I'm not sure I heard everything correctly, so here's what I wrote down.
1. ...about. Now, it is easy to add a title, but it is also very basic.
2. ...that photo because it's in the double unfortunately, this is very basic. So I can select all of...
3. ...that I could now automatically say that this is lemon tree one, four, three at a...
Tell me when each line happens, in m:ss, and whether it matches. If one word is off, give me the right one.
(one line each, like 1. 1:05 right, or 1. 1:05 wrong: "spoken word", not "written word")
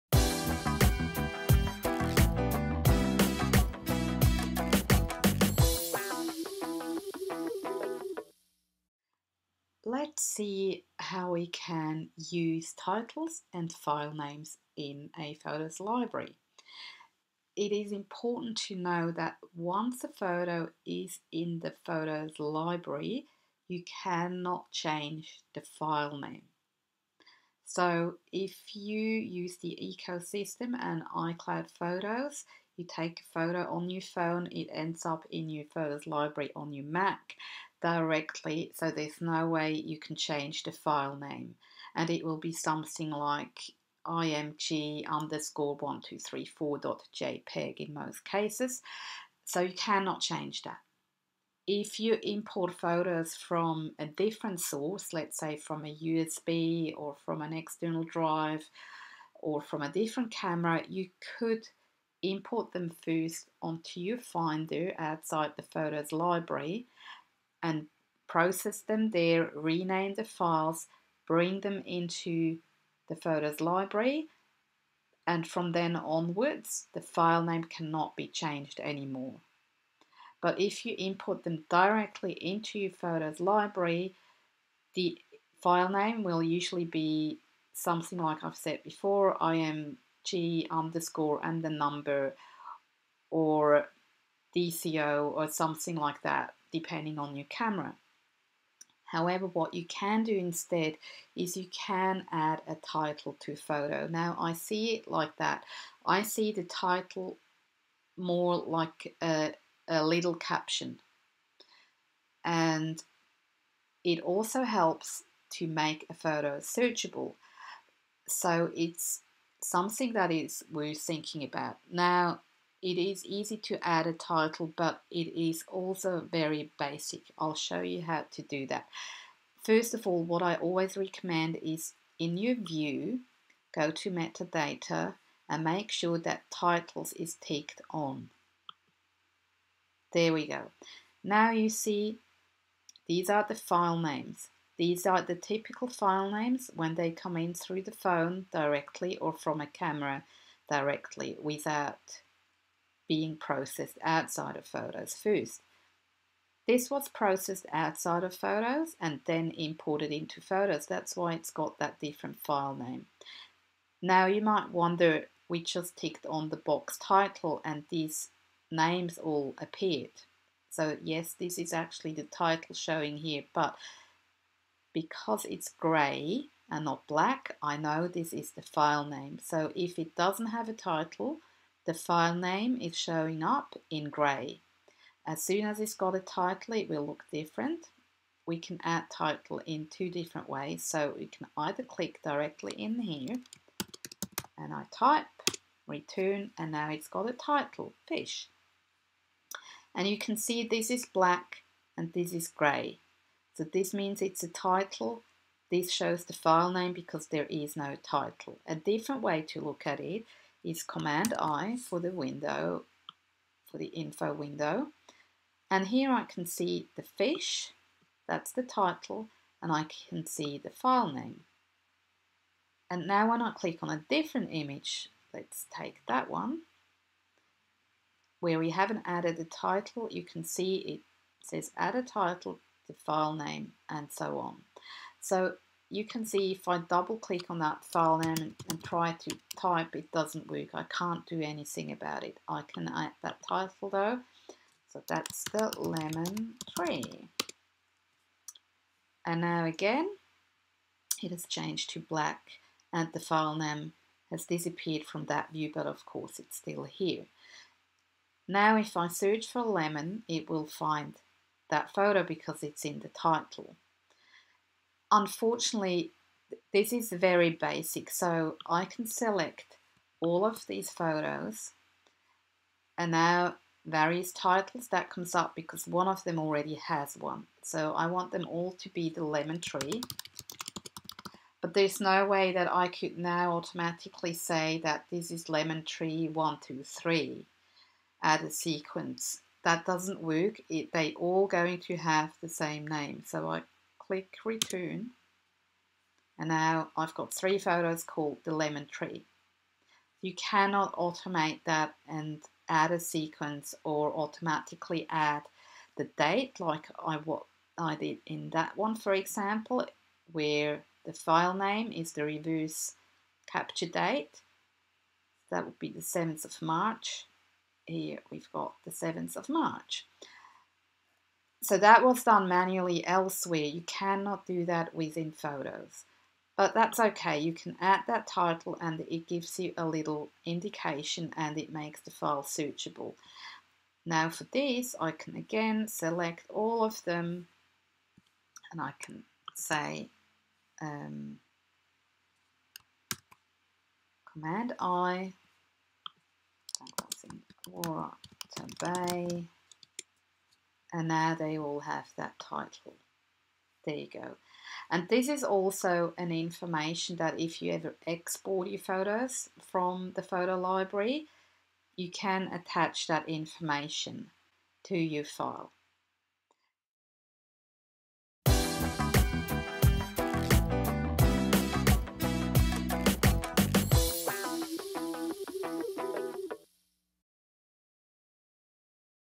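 1. 2:01 right
2. 4:21 wrong: "title", not "double"
3. 4:42 wrong: "two", not "four".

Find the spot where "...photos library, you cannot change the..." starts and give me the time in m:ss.
0:21.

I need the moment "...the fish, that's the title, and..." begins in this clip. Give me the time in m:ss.
3:36.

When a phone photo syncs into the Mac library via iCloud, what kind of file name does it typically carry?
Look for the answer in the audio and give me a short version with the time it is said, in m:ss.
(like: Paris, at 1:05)
IMG_1234.jpg, at 0:44.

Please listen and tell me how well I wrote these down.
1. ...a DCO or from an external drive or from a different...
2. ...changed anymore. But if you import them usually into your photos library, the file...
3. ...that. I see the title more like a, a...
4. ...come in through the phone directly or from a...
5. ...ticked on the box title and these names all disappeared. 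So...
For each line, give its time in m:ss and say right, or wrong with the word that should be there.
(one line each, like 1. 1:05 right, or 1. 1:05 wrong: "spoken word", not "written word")
1. 0:55 wrong: "USB", not "DCO"
2. 1:18 wrong: "directly", not "usually"
3. 1:45 right
4. 2:27 right
5. 2:45 wrong: "appeared", not "disappeared".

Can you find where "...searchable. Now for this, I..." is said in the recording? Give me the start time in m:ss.
5:32.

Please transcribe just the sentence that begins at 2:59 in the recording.
So if it doesn't have a title, the file name is showing up in grey.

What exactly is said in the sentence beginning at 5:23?
You cannot do that within Photos.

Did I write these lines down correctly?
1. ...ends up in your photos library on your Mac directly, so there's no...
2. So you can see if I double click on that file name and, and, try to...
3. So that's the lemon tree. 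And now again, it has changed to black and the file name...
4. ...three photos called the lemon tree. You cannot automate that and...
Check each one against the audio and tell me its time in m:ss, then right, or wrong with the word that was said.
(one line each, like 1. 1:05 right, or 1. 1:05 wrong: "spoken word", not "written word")
1. 0:34 right
2. 3:55 right
3. 4:04 right
4. 4:57 right.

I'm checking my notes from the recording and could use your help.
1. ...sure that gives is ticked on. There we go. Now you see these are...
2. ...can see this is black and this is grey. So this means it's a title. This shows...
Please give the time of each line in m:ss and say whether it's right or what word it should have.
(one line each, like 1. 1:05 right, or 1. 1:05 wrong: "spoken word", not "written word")
1. 2:15 wrong: "titles", not "gives"
2. 3:20 right.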